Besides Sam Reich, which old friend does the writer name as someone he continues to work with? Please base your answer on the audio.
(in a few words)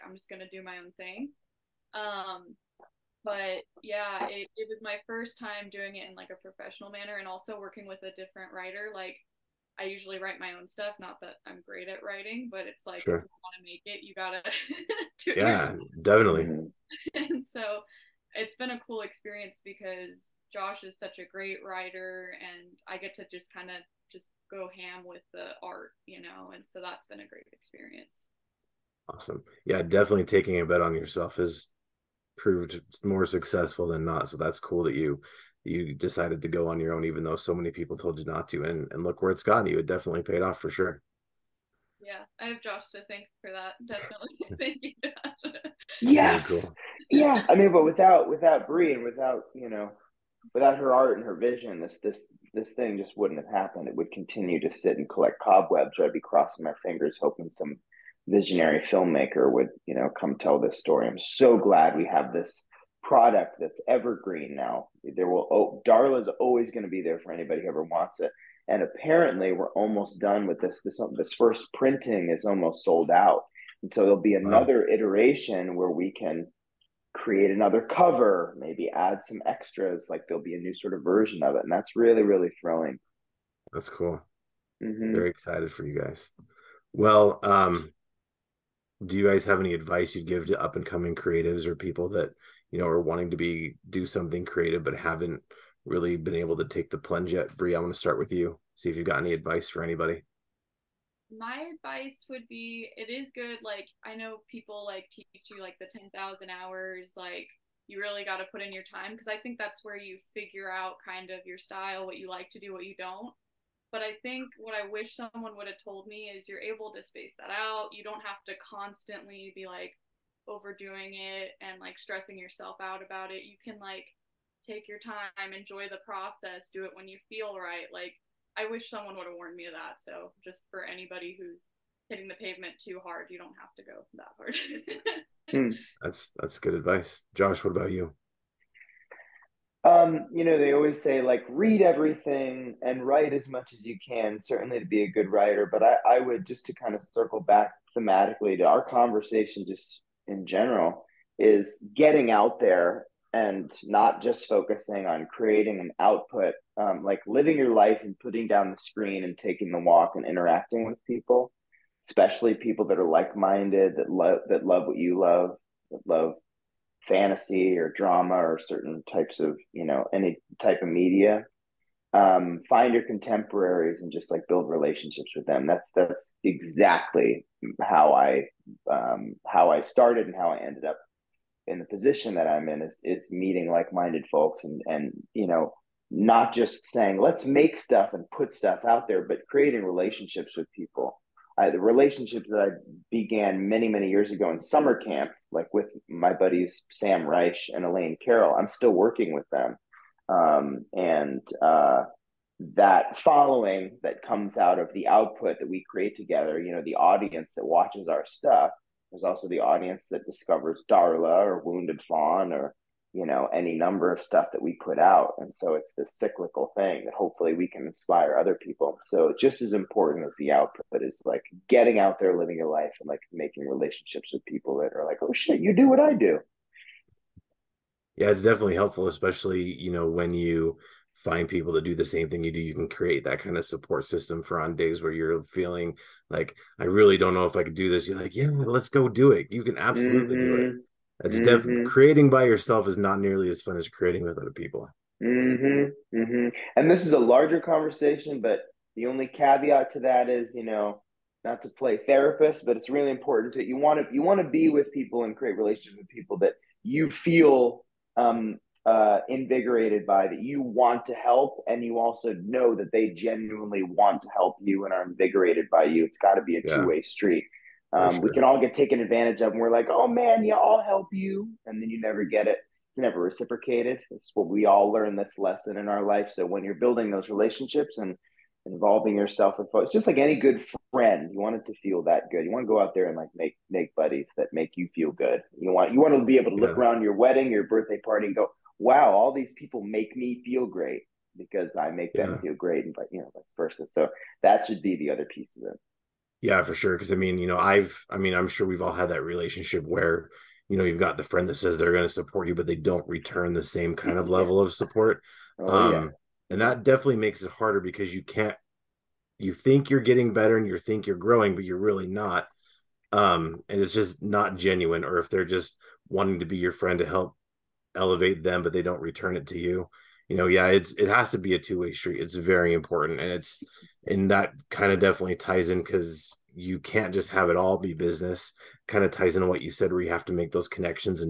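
Elaine Carroll.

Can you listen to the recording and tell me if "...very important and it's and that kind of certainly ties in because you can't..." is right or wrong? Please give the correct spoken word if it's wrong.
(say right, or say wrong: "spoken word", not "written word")
wrong: "definitely", not "certainly".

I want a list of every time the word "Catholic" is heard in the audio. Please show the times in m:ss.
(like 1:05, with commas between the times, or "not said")
not said.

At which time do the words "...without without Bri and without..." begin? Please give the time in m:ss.
0:47.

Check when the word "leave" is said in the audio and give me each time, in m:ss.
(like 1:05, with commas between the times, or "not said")
not said.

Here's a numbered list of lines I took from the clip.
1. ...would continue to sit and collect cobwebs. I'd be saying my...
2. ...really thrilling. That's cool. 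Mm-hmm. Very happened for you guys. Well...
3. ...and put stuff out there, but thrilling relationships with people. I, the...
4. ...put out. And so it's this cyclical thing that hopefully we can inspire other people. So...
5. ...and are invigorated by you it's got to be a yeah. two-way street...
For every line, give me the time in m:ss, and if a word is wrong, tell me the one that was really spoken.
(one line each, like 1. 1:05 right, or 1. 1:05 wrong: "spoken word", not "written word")
1. 0:53 wrong: "crossing", not "saying"
2. 1:22 wrong: "excited", not "happened"
3. 3:08 wrong: "creating", not "thrilling"
4. 3:34 right
5. 4:24 right.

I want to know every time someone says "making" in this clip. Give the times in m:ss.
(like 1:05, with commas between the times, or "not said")
3:43.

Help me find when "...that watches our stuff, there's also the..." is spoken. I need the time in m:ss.
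3:27.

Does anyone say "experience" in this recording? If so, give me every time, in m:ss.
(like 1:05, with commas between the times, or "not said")
0:19, 0:27.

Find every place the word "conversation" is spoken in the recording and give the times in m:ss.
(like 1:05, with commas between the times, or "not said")
2:28, 4:07.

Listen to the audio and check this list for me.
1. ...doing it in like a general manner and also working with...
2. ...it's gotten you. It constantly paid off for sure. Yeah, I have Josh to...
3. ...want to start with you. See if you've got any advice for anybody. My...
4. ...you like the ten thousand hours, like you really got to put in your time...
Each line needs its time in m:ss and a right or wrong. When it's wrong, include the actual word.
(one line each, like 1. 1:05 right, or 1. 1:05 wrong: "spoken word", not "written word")
1. 0:05 wrong: "professional", not "general"
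2. 0:39 wrong: "definitely", not "constantly"
3. 1:37 right
4. 1:45 right.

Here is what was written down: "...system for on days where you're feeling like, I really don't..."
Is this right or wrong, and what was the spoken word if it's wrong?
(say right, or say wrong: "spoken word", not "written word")
right.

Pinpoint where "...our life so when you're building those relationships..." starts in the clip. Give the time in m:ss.
4:35.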